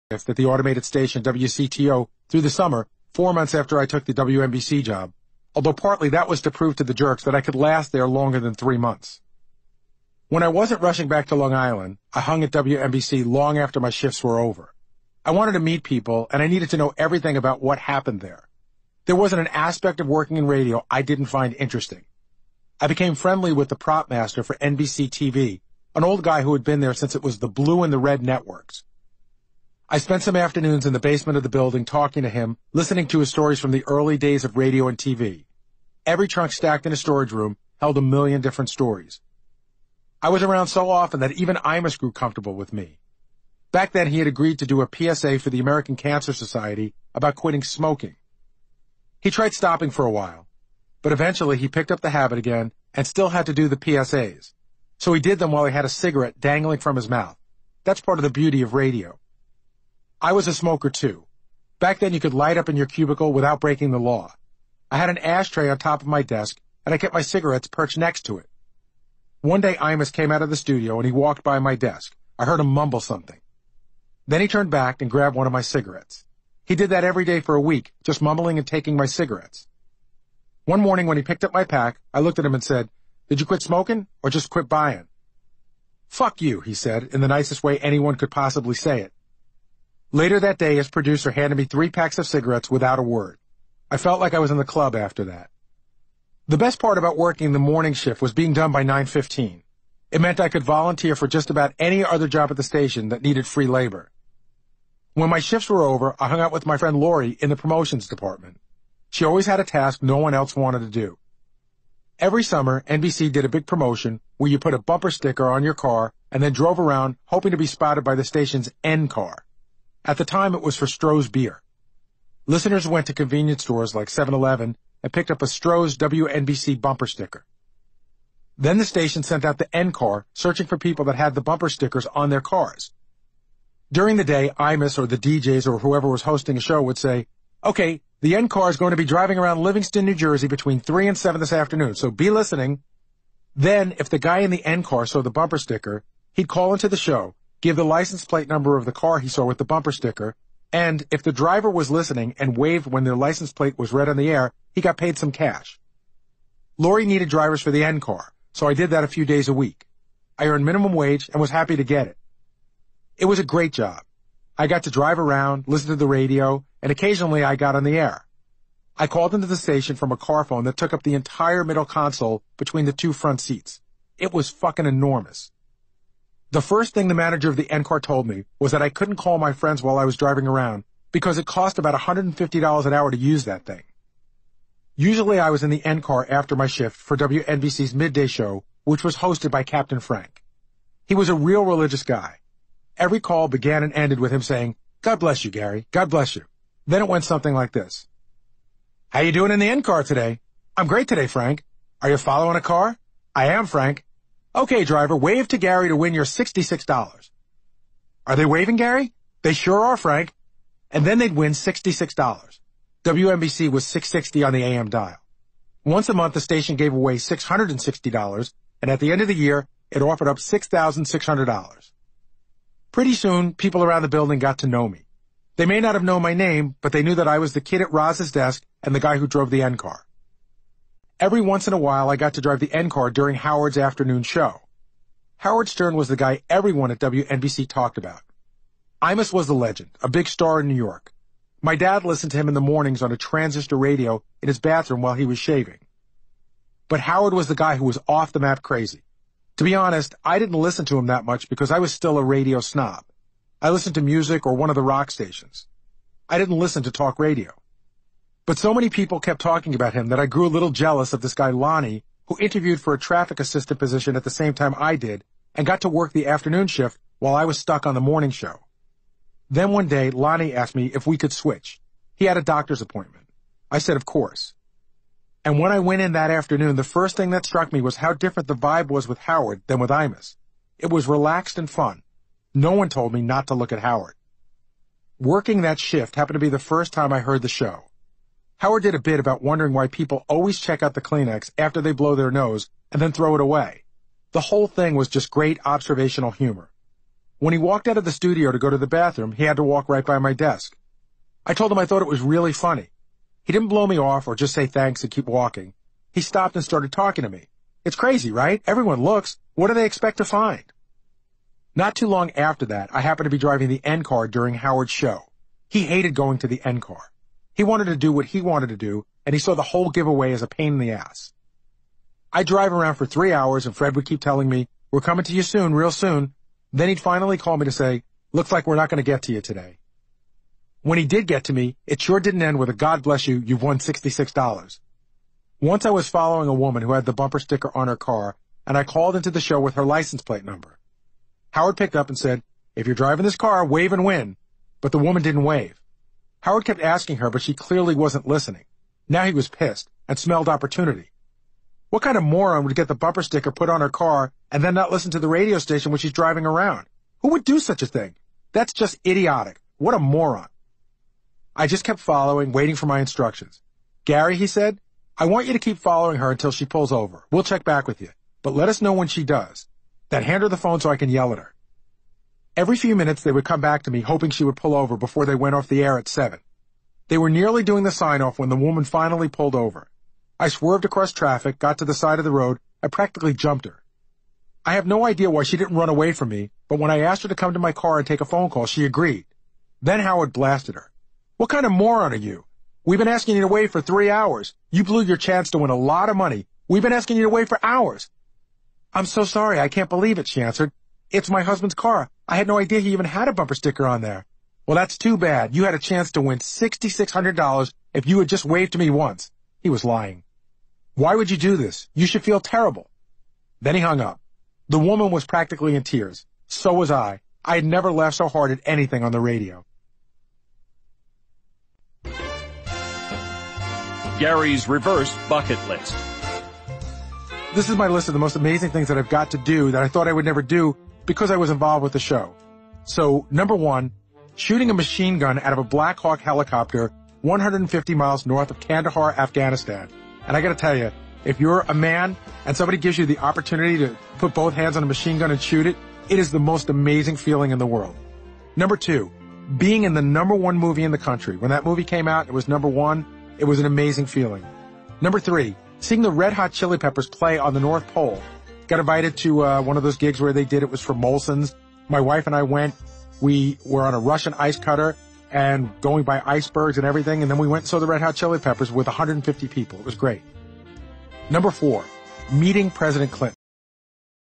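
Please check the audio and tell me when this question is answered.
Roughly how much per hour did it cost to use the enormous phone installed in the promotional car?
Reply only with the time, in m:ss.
3:01.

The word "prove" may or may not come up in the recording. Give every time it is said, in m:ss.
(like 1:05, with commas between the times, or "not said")
0:06.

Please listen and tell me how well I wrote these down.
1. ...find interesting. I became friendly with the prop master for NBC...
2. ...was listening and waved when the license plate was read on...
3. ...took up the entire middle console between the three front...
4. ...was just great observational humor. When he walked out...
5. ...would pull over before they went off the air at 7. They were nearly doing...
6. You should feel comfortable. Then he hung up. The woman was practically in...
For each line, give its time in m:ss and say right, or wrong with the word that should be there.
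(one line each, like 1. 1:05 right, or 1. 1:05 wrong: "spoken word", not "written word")
1. 0:21 right
2. 2:31 right
3. 2:50 wrong: "two", not "three"
4. 4:54 right
5. 6:14 right
6. 6:51 wrong: "terrible", not "comfortable".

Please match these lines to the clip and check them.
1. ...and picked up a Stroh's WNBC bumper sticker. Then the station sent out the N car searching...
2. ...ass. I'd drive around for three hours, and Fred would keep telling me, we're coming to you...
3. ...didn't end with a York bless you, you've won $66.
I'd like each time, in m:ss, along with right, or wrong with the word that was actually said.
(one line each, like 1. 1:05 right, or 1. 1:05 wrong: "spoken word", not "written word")
1. 2:05 right
2. 5:20 right
3. 5:32 wrong: "God", not "York".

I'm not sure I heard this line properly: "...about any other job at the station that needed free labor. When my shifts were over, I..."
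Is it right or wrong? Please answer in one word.
right.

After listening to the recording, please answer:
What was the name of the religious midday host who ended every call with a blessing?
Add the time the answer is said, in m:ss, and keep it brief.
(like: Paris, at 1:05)
Captain Frank, at 3:09.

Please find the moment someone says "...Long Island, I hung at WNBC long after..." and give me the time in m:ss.
0:11.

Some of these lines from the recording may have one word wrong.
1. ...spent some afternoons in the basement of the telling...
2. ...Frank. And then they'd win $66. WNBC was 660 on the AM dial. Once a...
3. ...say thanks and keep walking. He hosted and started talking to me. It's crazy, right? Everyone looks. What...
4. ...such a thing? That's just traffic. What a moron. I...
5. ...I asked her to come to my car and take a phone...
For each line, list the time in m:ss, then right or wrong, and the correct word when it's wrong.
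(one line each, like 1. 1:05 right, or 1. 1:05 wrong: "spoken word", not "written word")
1. 0:29 wrong: "building", not "telling"
2. 3:29 right
3. 5:04 wrong: "stopped", not "hosted"
4. 5:57 wrong: "idiotic", not "traffic"
5. 6:26 right.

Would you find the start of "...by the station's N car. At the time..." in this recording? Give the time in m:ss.
1:58.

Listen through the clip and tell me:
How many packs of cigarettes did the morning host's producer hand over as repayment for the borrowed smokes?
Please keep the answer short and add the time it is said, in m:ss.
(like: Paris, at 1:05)
3, at 1:31.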